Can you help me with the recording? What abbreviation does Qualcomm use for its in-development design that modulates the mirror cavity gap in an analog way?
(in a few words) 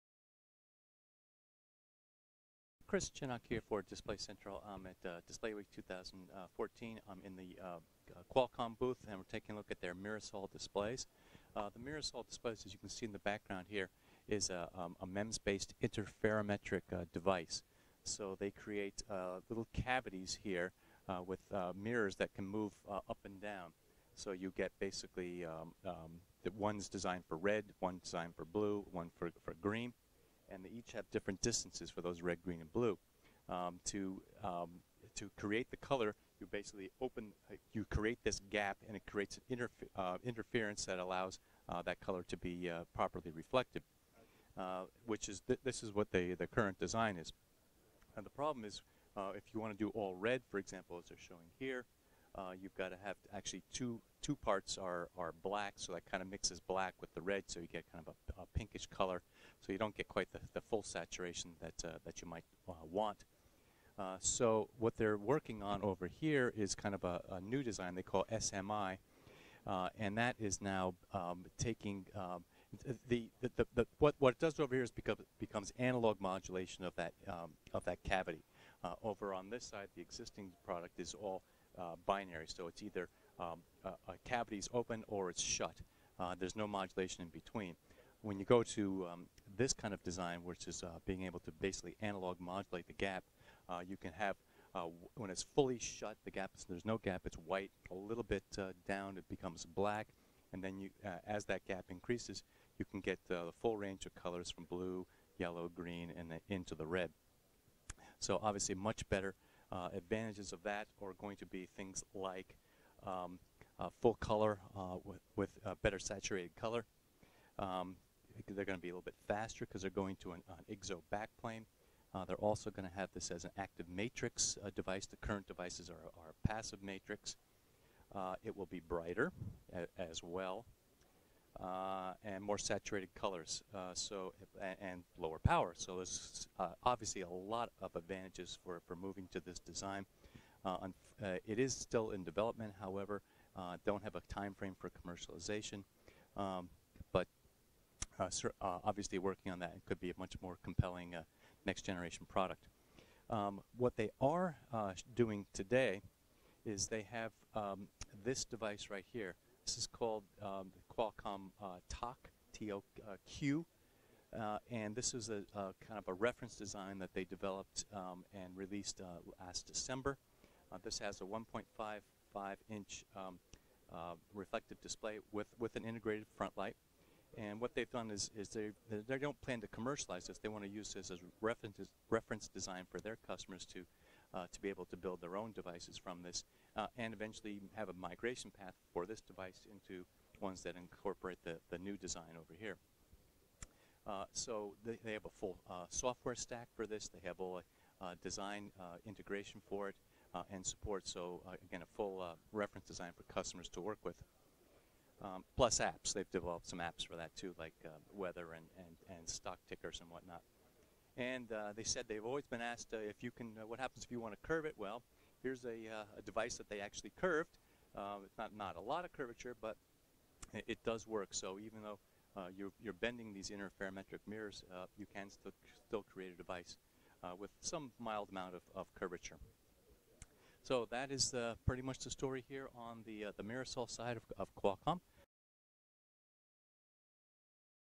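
SMI.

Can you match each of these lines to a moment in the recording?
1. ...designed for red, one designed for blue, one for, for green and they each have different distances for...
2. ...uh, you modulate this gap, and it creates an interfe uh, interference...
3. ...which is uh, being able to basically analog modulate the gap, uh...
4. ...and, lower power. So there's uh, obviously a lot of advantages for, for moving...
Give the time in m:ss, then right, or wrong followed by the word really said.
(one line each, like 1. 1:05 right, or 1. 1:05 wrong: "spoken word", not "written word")
1. 0:26 right
2. 0:37 wrong: "create", not "modulate"
3. 1:30 right
4. 2:14 right.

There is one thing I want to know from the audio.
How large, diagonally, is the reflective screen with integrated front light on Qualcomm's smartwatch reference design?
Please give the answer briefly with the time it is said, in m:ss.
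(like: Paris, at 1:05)
1.55 inch, at 2:51.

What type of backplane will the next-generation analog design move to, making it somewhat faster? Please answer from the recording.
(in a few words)
IGZO.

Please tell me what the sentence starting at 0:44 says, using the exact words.
Uh, which is th this is what the the current design is.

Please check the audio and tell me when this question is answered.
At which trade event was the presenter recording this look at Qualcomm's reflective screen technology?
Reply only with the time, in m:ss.
0:05.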